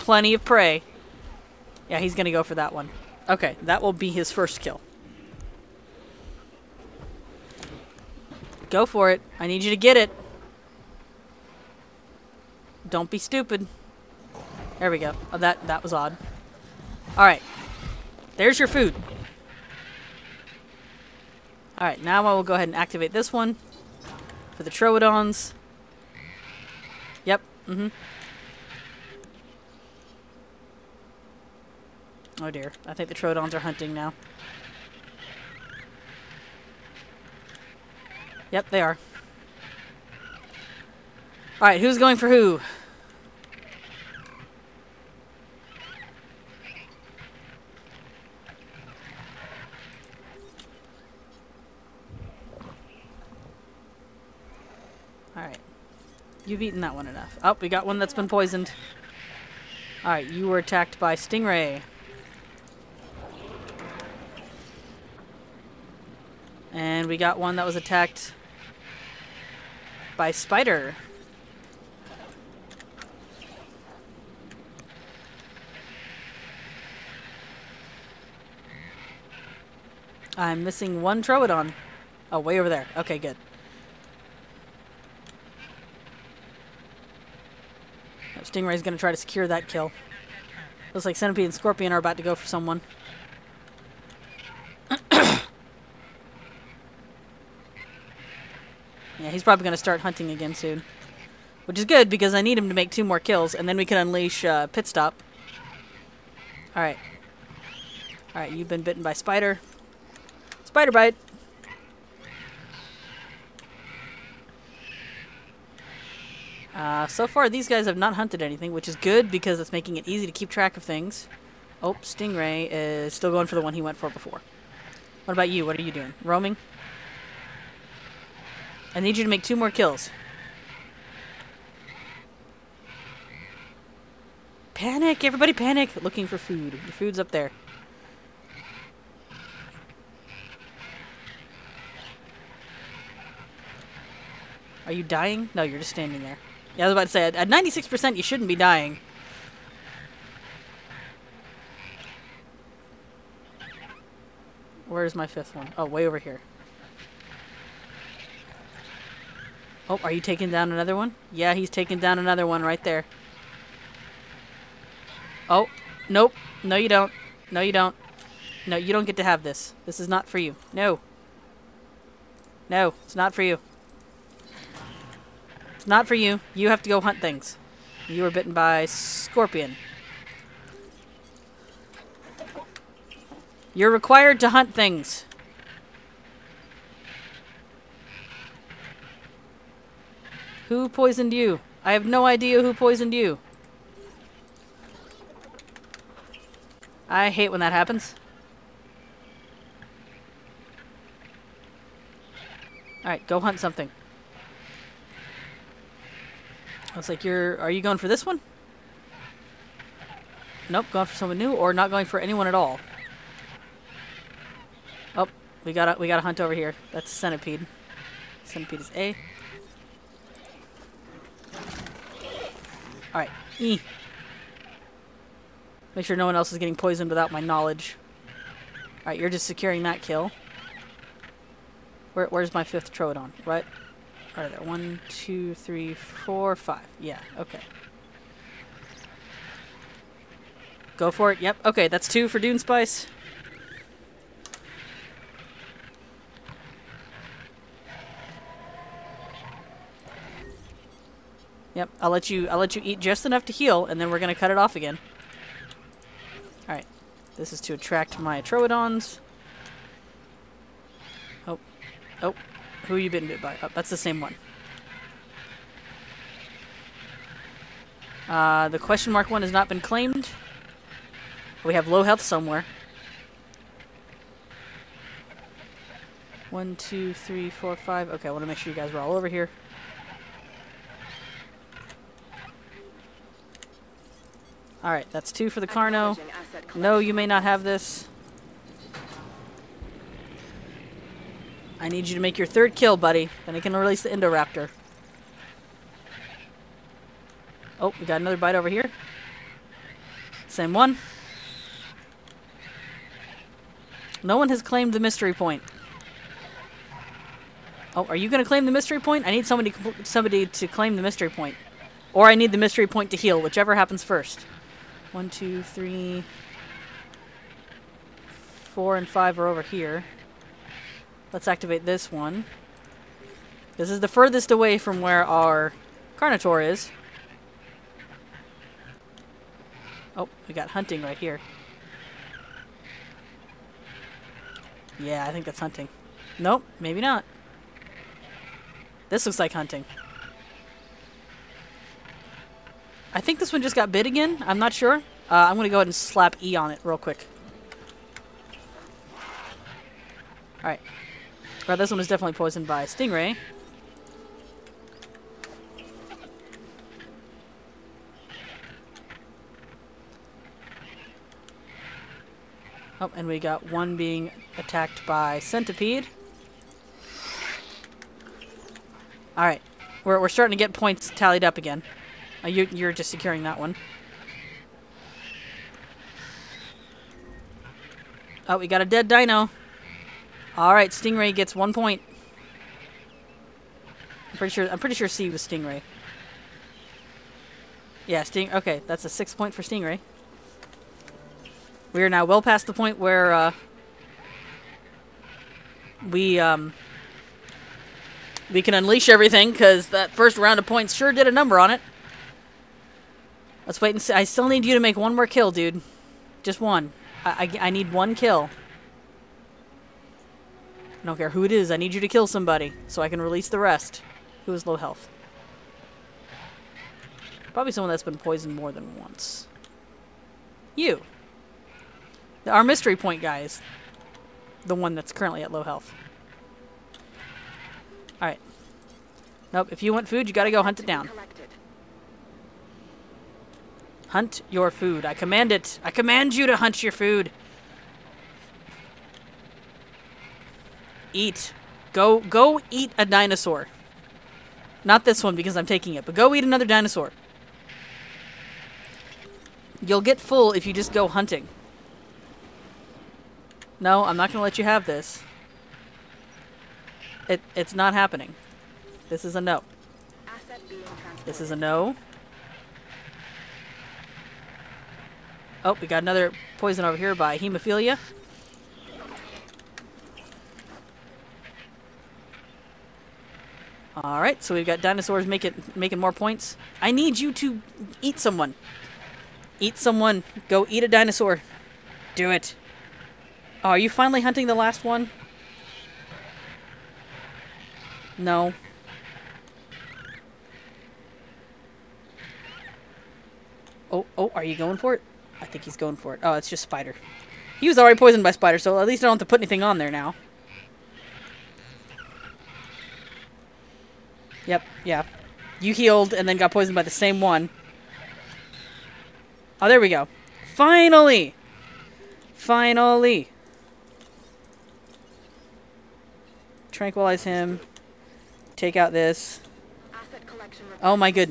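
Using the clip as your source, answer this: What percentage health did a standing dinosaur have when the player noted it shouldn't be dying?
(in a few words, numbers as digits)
96%.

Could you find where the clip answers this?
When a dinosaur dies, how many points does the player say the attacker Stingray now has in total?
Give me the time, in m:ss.
6:29.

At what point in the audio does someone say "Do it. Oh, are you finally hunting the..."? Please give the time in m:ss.
8:02.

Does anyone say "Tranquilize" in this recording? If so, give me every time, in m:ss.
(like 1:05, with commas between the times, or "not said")
8:36.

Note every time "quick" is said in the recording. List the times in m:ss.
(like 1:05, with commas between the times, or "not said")
5:46.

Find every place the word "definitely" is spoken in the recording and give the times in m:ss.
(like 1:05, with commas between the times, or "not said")
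5:52.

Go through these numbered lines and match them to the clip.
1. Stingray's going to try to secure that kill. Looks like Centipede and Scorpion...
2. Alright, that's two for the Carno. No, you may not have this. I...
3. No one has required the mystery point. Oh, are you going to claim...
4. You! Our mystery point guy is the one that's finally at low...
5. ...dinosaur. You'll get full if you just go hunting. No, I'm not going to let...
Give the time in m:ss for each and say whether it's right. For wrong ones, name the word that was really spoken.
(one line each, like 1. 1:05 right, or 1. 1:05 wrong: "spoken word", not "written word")
1. 1:28 right
2. 4:44 right
3. 5:04 wrong: "claimed", not "required"
4. 7:00 wrong: "currently", not "finally"
5. 7:26 right.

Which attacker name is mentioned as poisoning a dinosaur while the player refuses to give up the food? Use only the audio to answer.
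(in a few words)
hemophilia.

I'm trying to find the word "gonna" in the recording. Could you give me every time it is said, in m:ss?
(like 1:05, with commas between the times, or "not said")
4:14.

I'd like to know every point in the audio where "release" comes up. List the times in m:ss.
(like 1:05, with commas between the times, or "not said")
4:53, 6:53.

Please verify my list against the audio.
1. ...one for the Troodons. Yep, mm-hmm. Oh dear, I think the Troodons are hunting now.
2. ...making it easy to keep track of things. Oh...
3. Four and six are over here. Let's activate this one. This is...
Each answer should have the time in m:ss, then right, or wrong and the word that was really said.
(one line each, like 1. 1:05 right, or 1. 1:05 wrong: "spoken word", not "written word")
1. 0:23 right
2. 1:59 right
3. 5:18 wrong: "five", not "six".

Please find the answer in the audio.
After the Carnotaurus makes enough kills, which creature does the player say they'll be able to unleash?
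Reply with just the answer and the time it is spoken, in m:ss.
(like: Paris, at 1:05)
Pit Stop, at 1:44.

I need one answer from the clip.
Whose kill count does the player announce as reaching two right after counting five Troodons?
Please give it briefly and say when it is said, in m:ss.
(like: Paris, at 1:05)
Dune Spice, at 4:02.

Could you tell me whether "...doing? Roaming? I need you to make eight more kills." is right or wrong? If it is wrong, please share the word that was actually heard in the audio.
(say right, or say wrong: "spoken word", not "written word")
wrong: "two", not "eight".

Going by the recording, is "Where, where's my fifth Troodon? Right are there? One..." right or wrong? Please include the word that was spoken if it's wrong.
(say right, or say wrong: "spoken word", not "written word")
right.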